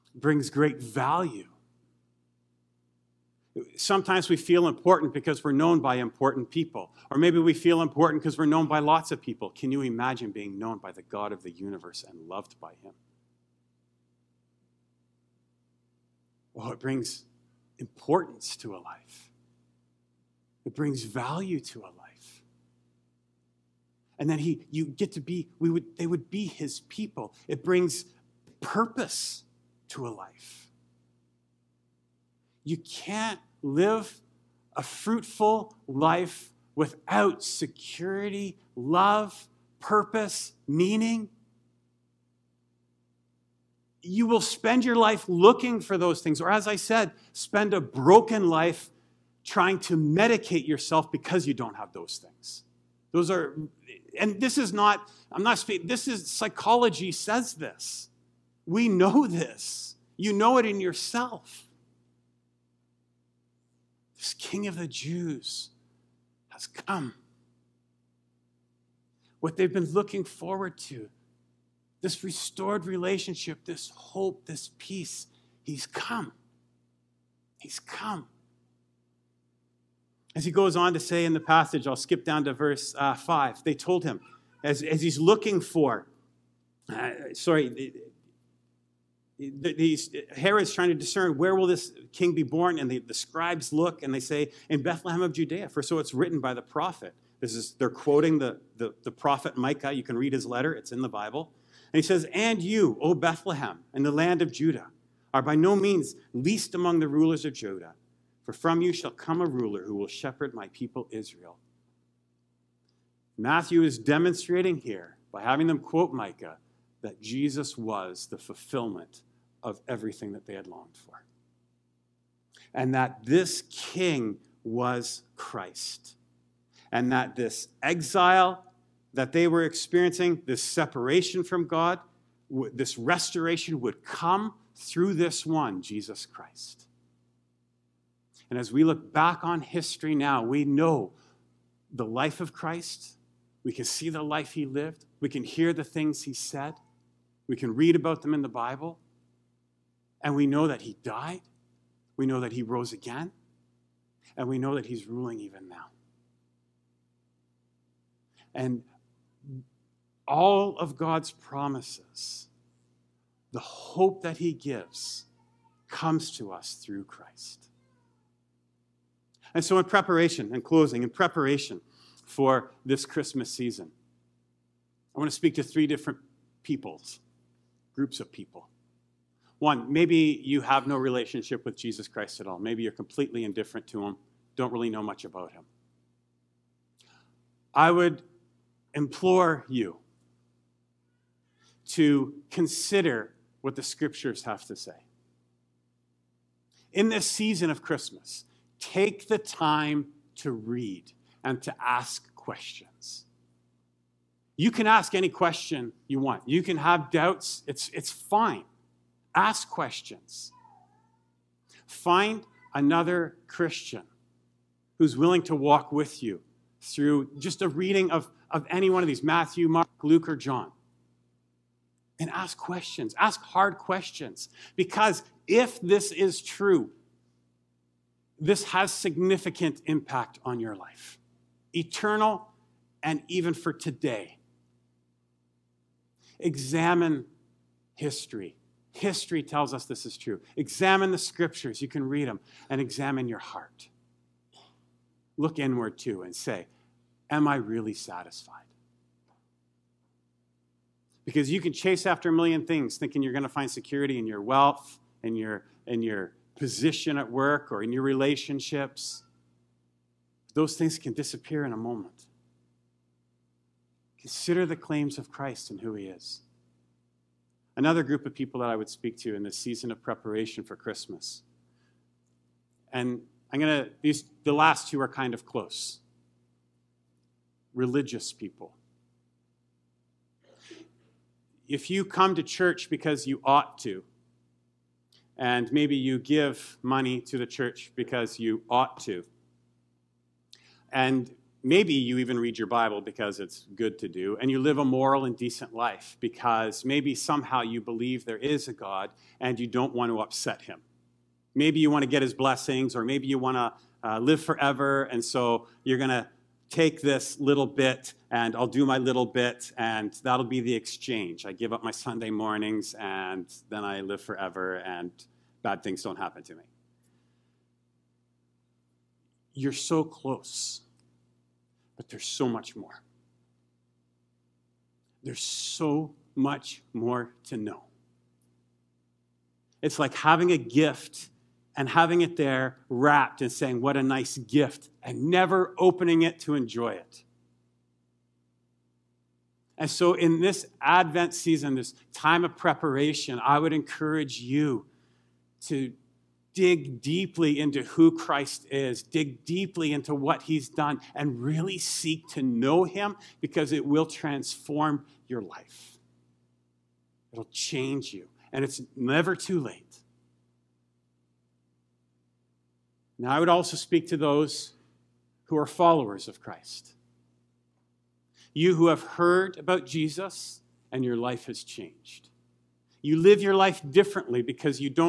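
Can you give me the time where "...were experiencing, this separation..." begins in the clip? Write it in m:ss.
2:09.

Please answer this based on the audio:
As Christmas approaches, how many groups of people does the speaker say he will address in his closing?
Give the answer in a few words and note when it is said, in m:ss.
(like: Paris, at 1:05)
3, at 2:55.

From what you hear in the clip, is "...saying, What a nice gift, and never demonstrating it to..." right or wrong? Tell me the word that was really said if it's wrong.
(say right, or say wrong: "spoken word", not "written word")
wrong: "opening", not "demonstrating".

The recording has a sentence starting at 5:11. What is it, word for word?
I give up my Sunday mornings and then I live forever, and bad things don't happen to me.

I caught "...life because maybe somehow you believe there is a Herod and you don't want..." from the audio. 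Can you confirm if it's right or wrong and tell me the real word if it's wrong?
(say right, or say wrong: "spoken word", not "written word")
wrong: "God", not "Herod".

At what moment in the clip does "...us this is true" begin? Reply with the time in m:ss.
3:59.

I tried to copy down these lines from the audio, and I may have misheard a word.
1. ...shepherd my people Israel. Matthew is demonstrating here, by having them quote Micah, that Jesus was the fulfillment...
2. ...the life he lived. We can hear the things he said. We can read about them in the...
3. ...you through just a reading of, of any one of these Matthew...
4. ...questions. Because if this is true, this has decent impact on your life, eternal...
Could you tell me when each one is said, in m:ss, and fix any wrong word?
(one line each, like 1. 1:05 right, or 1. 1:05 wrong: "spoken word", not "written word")
1. 1:50 right
2. 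2:24 right
3. 3:36 right
4. 3:43 wrong: "significant", not "decent".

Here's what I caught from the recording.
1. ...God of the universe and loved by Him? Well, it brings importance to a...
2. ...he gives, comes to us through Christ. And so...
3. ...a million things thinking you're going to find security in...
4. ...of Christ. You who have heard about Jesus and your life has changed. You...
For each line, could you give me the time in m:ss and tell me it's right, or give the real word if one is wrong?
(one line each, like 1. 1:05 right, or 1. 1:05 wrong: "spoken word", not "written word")
1. 0:11 right
2. 2:44 right
3. 4:12 right
4. 6:06 right.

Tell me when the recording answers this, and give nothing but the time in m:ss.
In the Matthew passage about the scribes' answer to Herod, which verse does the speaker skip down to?
1:22.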